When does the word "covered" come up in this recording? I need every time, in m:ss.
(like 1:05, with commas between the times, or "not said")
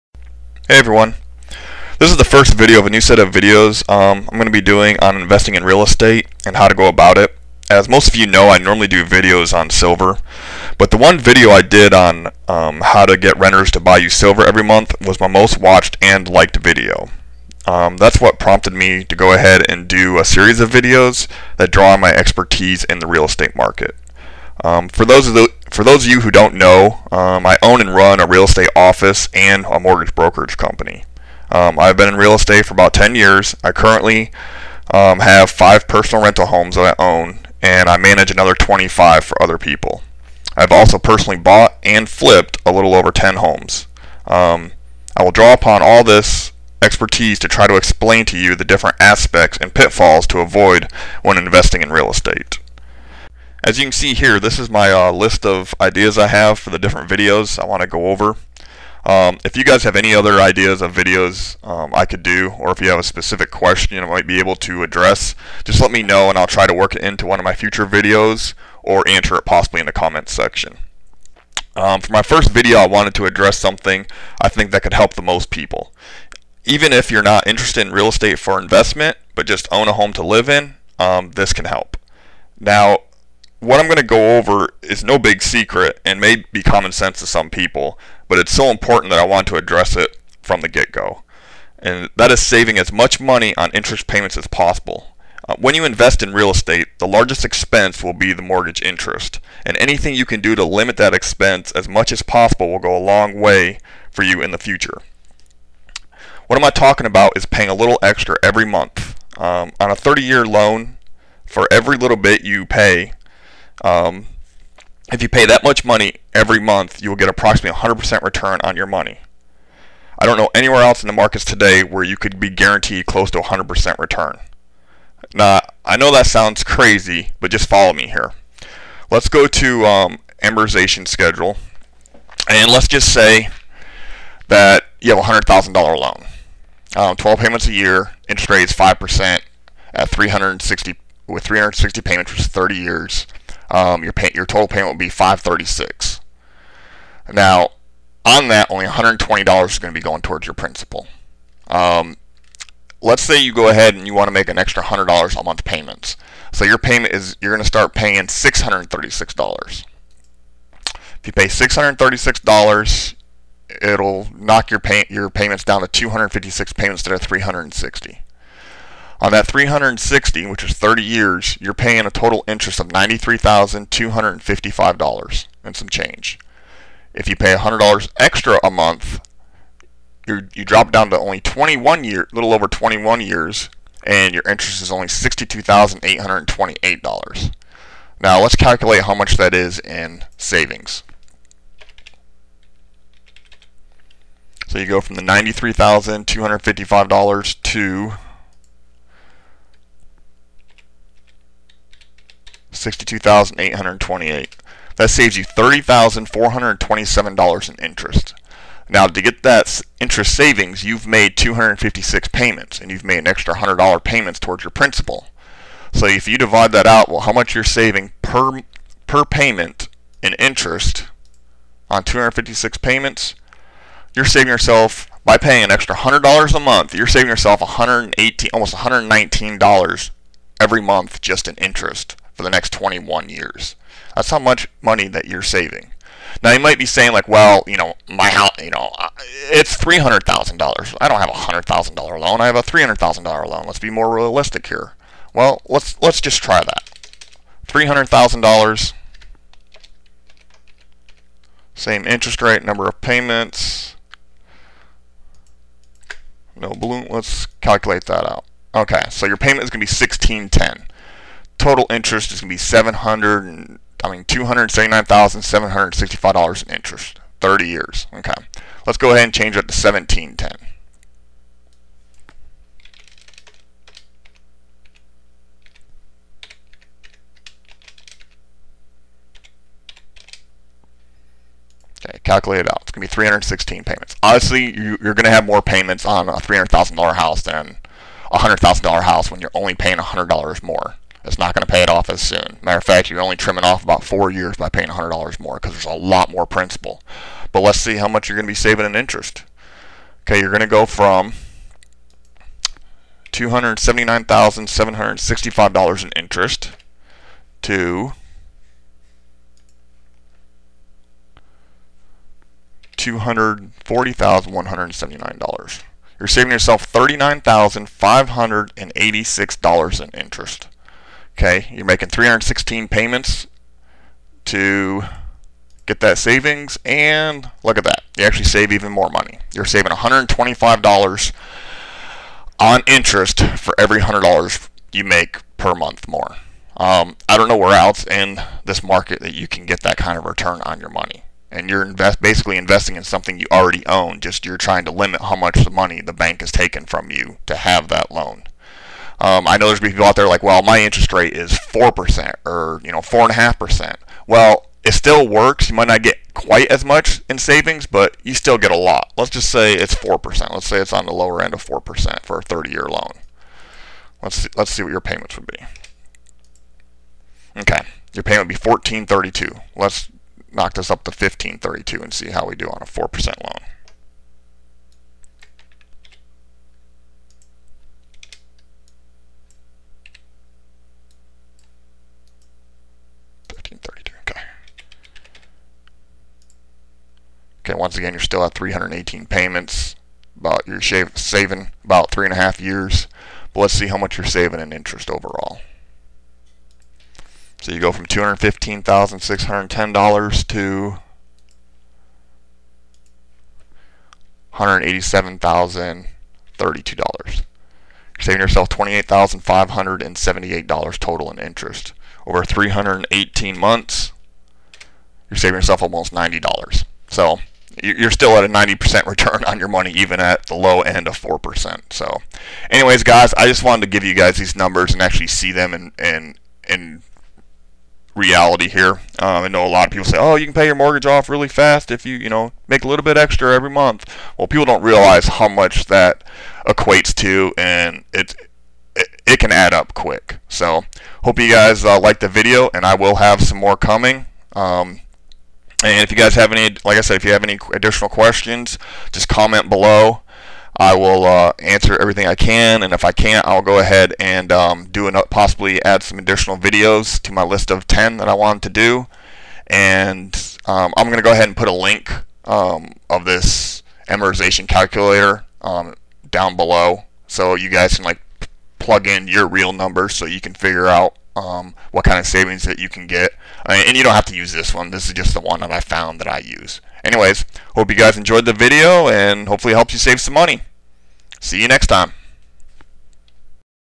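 not said.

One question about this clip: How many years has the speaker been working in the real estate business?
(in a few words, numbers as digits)
10 years.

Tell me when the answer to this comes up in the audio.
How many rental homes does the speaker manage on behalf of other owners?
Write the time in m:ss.
0:38.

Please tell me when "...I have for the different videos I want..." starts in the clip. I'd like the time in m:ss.
0:56.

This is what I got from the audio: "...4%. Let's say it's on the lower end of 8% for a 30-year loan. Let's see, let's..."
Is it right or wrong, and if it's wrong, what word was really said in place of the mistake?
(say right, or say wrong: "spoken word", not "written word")
wrong: "4", not "8".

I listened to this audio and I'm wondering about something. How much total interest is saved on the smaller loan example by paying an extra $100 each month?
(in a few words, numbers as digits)
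$30,427.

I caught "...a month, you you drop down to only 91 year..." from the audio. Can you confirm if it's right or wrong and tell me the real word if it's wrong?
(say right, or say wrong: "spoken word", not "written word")
wrong: "21", not "91".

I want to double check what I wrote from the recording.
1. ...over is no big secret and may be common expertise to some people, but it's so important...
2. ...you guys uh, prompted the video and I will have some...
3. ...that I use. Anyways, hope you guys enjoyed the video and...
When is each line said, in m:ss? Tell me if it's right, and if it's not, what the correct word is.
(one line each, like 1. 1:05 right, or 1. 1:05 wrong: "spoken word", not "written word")
1. 1:24 wrong: "sense", not "expertise"
2. 7:21 wrong: "liked", not "prompted"
3. 7:56 right.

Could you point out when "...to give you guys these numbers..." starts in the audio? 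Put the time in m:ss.
7:03.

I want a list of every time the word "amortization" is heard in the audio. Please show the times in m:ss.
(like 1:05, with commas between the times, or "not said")
2:10, 7:44.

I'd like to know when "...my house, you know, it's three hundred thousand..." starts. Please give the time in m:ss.
3:58.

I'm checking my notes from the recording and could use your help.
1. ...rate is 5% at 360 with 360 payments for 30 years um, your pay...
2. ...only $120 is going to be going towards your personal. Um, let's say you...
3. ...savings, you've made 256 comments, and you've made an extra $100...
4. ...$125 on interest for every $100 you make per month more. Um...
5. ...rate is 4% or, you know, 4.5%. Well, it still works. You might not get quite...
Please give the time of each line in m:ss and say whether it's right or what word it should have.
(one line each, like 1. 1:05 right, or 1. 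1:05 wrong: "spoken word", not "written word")
1. 2:18 right
2. 2:28 wrong: "principal", not "personal"
3. 3:30 wrong: "payments", not "comments"
4. 5:29 right
5. 5:51 right.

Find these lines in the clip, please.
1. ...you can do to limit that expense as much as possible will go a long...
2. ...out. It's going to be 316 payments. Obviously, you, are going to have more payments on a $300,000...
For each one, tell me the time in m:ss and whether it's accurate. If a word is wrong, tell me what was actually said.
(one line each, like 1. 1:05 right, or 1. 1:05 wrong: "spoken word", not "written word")
1. 1:40 right
2. 4:42 right.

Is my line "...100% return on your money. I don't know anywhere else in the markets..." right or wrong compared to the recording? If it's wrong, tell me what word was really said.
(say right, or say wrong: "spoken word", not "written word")
right.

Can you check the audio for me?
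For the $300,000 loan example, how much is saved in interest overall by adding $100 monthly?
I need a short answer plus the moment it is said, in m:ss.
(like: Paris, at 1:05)
$39,586, at 5:16.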